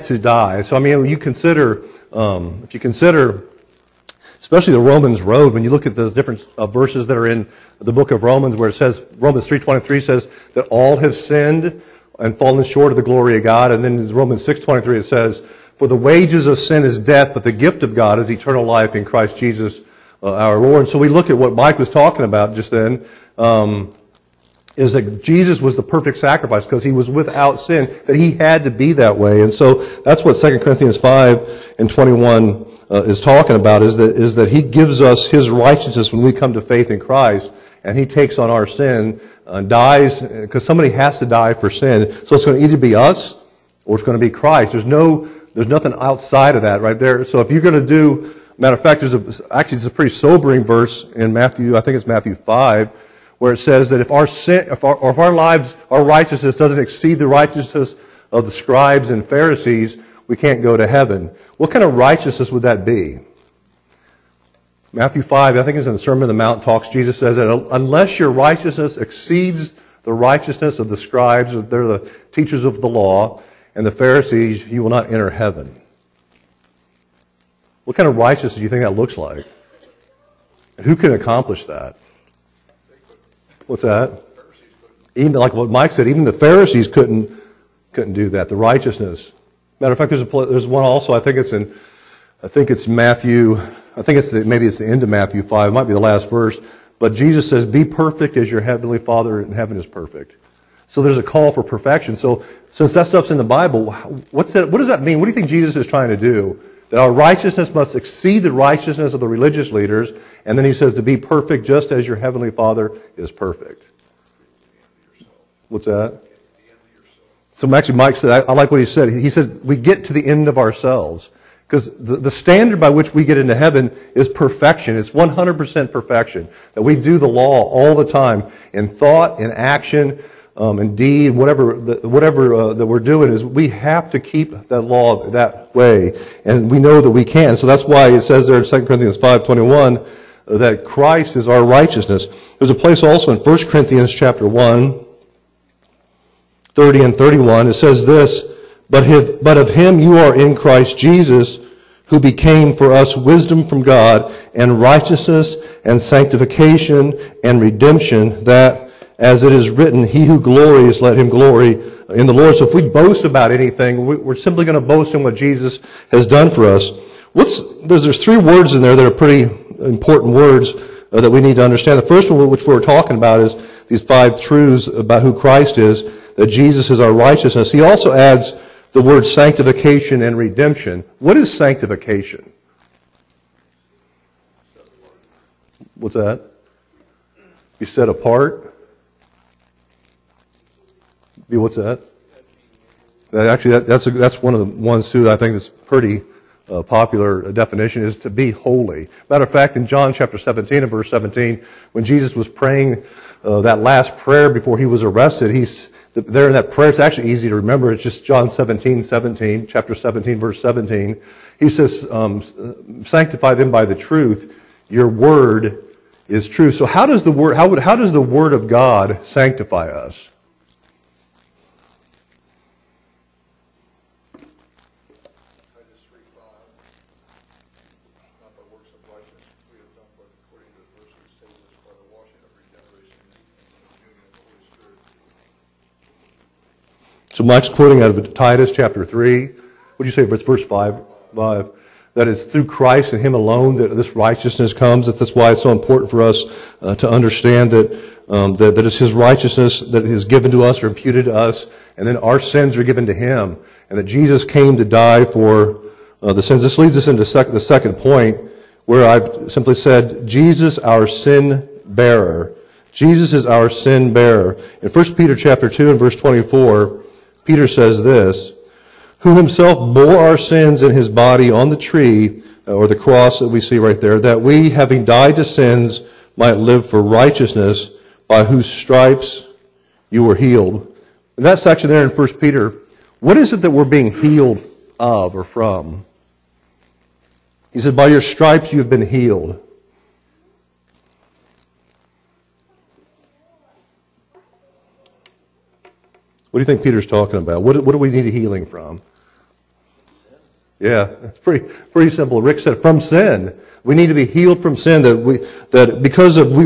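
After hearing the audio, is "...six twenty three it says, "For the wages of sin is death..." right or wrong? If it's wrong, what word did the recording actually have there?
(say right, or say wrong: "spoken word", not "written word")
right.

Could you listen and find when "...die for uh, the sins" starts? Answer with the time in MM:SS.
04:14.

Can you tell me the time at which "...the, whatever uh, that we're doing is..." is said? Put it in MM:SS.
02:11.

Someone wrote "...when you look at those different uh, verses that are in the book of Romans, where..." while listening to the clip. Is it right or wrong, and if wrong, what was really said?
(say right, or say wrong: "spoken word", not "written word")
right.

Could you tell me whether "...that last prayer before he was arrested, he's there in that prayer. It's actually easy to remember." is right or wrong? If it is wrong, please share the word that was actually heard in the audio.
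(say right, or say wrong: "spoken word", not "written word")
right.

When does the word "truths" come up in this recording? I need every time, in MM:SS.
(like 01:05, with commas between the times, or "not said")
02:54, 03:33.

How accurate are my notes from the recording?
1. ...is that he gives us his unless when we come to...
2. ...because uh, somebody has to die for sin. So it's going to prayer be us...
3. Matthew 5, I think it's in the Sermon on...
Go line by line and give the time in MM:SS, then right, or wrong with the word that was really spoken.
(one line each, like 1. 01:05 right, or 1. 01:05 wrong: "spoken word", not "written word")
1. 00:34 wrong: "righteousness", not "unless"
2. 00:40 wrong: "either", not "prayer"
3. 01:04 right.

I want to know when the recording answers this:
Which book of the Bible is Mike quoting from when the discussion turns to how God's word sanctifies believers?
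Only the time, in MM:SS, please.
03:58.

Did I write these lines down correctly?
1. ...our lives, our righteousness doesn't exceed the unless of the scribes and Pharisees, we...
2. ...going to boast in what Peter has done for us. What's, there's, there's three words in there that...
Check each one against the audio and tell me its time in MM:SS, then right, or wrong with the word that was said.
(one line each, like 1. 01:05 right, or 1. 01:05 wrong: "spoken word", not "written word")
1. 00:55 wrong: "righteousness", not "unless"
2. 02:44 wrong: "Jesus", not "Peter".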